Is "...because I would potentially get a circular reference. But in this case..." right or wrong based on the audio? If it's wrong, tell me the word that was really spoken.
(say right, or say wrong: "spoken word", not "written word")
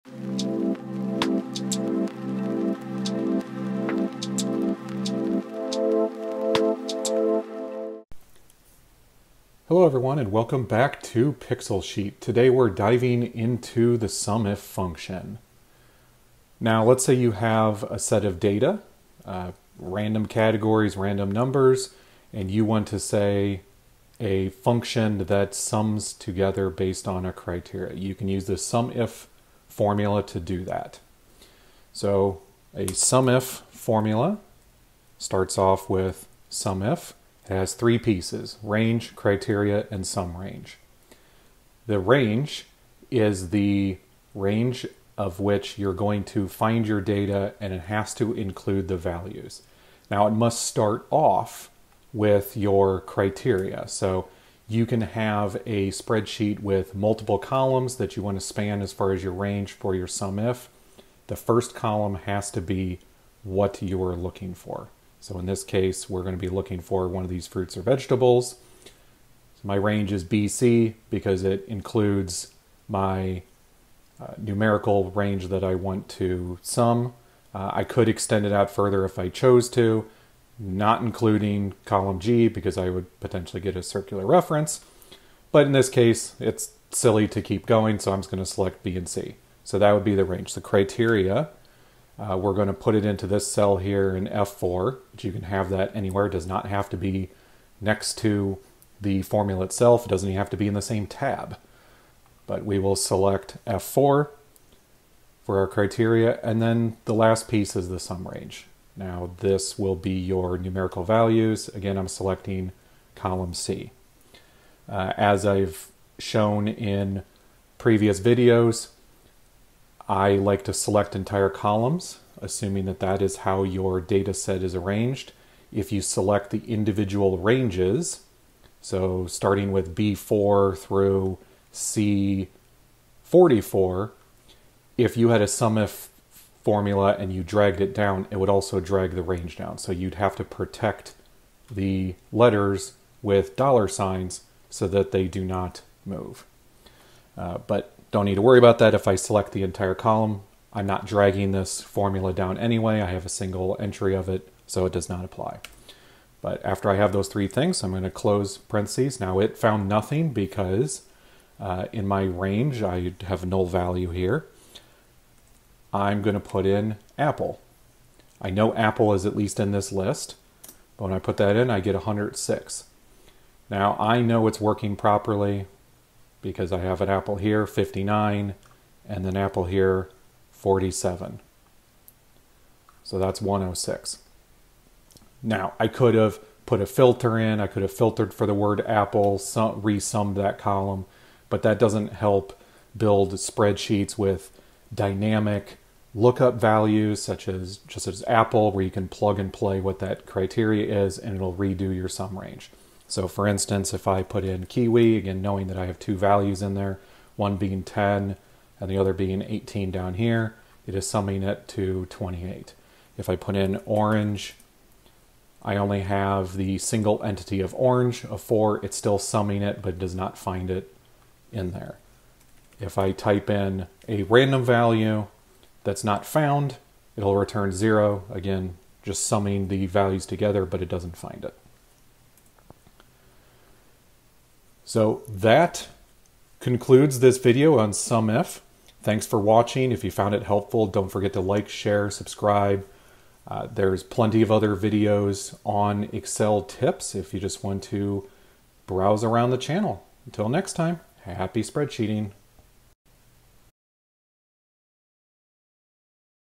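right.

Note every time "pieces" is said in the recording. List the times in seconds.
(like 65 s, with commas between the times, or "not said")
37 s, 107 s.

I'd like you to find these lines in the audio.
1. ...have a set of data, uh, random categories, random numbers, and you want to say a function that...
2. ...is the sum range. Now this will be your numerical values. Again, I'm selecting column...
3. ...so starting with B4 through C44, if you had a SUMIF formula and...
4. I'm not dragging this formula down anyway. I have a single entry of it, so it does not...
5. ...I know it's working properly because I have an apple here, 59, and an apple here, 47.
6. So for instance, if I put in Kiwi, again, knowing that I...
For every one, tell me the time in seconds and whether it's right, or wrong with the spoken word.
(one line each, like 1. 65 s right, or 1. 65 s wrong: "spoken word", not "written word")
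1. 17 s right
2. 107 s right
3. 128 s right
4. 150 s right
5. 173 s right
6. 203 s right.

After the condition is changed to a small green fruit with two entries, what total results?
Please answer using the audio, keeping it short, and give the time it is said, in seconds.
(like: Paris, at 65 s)
28, at 212 s.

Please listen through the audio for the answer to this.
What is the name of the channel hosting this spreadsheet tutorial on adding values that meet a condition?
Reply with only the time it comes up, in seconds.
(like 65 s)
11 s.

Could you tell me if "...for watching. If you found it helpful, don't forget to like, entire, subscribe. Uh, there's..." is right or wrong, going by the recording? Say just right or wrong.
wrong.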